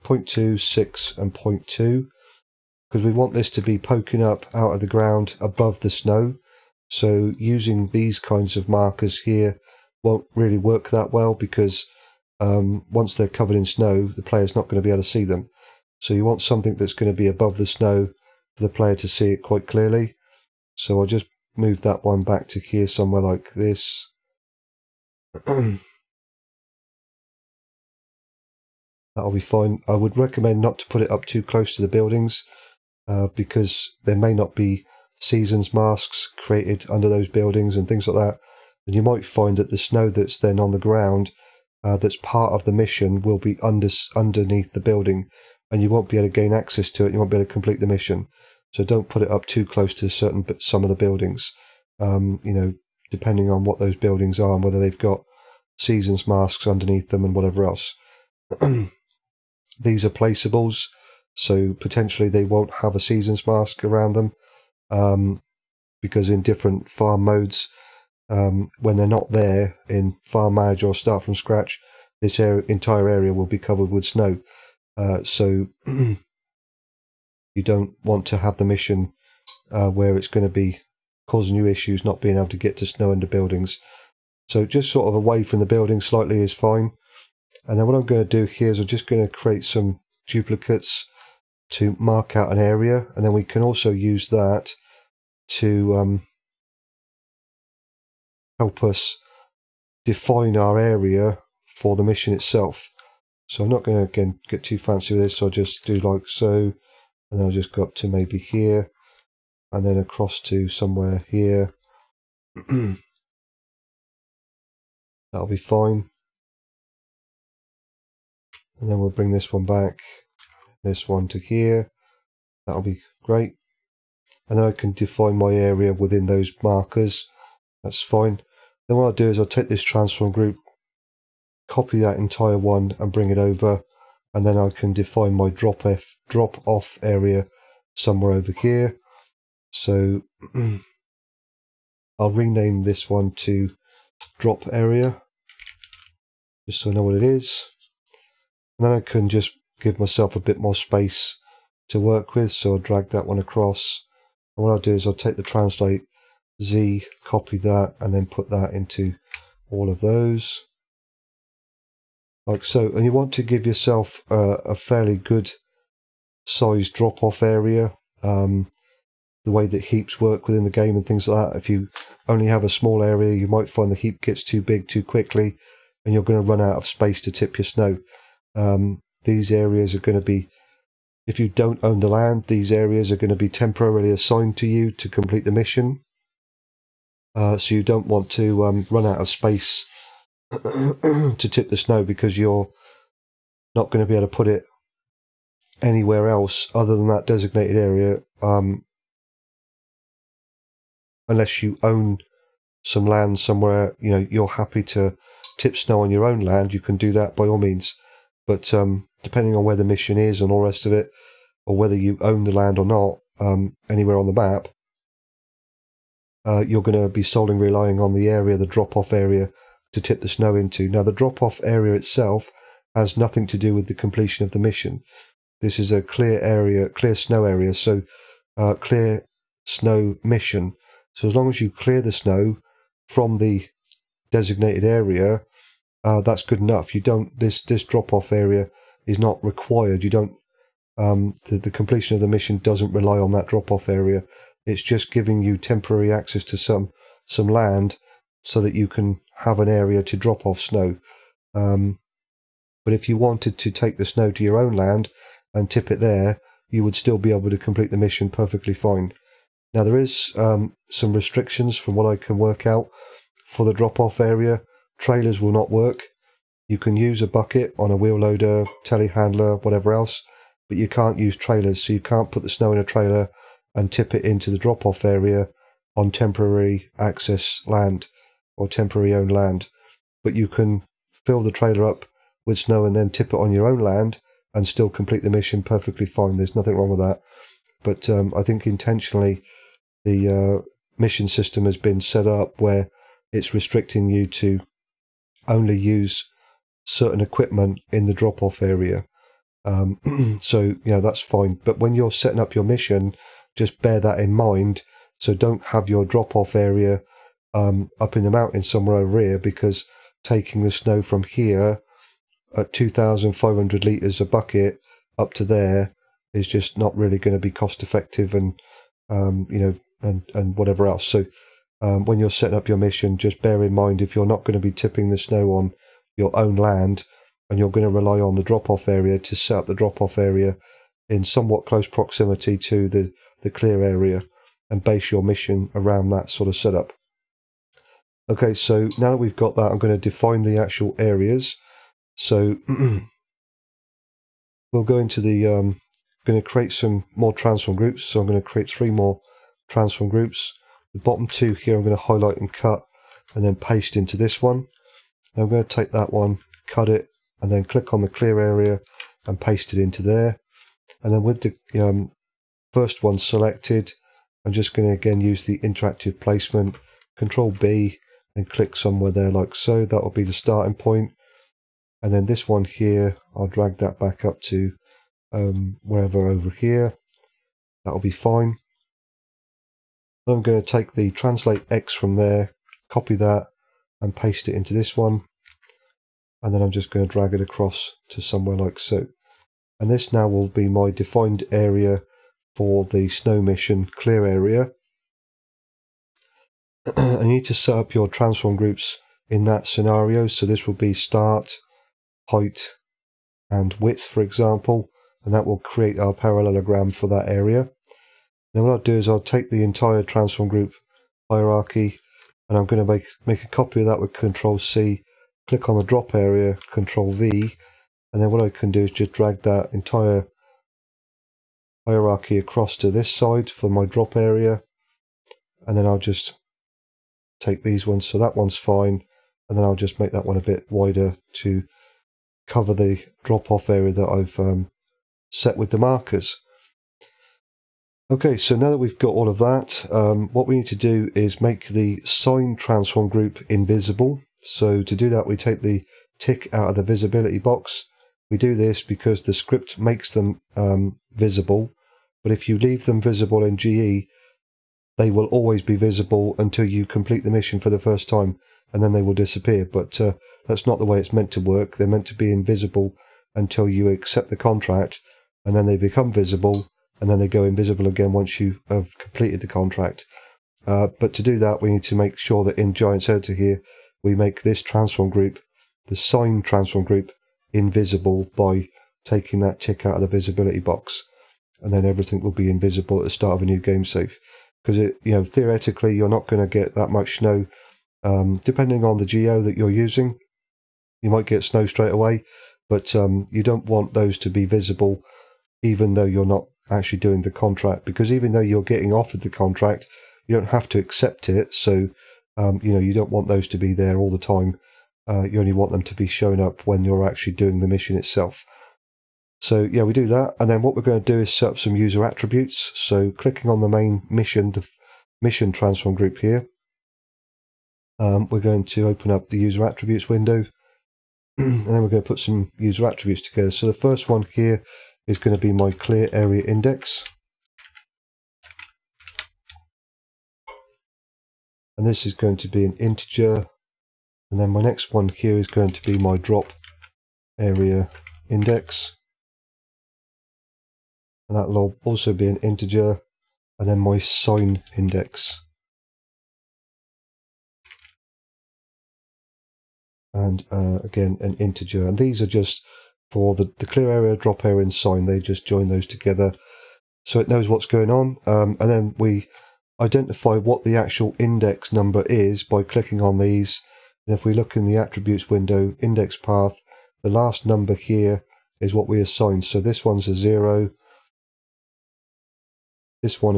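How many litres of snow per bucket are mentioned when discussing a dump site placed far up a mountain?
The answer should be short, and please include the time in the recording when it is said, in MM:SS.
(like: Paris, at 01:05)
2,500, at 05:12.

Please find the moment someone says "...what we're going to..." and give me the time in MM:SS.
08:30.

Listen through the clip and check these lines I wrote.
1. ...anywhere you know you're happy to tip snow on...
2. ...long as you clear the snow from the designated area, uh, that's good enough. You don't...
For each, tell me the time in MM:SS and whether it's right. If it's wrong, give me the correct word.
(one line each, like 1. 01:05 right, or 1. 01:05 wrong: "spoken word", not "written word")
1. 03:23 wrong: "somewhere", not "anywhere"
2. 03:51 right.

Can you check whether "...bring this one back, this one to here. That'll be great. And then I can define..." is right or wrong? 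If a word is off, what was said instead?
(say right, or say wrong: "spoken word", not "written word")
right.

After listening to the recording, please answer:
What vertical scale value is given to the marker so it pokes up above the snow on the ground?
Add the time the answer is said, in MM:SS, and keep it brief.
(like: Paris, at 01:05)
6, at 00:00.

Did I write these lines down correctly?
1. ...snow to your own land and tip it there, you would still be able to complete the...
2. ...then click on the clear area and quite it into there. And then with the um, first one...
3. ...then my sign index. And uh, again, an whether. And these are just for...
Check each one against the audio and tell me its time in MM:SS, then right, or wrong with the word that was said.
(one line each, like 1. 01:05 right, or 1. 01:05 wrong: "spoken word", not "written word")
1. 04:14 right
2. 05:57 wrong: "paste", not "quite"
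3. 09:03 wrong: "integer", not "whether".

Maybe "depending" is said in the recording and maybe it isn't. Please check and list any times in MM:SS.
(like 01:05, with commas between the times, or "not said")
00:53, 03:29, 08:08.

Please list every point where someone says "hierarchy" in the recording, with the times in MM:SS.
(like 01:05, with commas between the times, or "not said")
06:51, 07:01.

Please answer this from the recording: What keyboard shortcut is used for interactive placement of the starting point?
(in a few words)
Control B.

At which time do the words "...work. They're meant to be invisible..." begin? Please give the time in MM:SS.
07:41.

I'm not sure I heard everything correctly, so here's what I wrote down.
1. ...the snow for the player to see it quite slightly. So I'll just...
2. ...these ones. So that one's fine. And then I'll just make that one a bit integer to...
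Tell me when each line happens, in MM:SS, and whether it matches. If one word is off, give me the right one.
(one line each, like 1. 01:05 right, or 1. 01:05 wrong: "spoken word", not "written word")
1. 00:17 wrong: "clearly", not "slightly"
2. 07:07 wrong: "wider", not "integer".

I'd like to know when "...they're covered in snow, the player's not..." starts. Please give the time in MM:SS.
00:13.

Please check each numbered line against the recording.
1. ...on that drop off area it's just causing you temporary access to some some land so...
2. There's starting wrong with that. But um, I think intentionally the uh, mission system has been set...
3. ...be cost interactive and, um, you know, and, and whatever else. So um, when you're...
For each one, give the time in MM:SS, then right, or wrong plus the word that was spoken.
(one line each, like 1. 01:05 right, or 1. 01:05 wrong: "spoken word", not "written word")
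1. 04:03 wrong: "giving", not "causing"
2. 04:46 wrong: "nothing", not "starting"
3. 05:17 wrong: "effective", not "interactive".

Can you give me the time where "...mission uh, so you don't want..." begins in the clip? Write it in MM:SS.
03:05.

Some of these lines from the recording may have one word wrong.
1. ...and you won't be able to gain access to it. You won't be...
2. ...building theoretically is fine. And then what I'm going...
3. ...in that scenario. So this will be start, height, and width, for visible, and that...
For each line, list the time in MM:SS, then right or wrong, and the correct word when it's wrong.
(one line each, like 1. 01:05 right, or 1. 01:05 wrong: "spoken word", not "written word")
1. 00:45 right
2. 01:25 wrong: "slightly", not "theoretically"
3. 06:39 wrong: "example", not "visible".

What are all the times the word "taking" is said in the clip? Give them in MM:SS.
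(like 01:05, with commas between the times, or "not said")
05:10, 07:59.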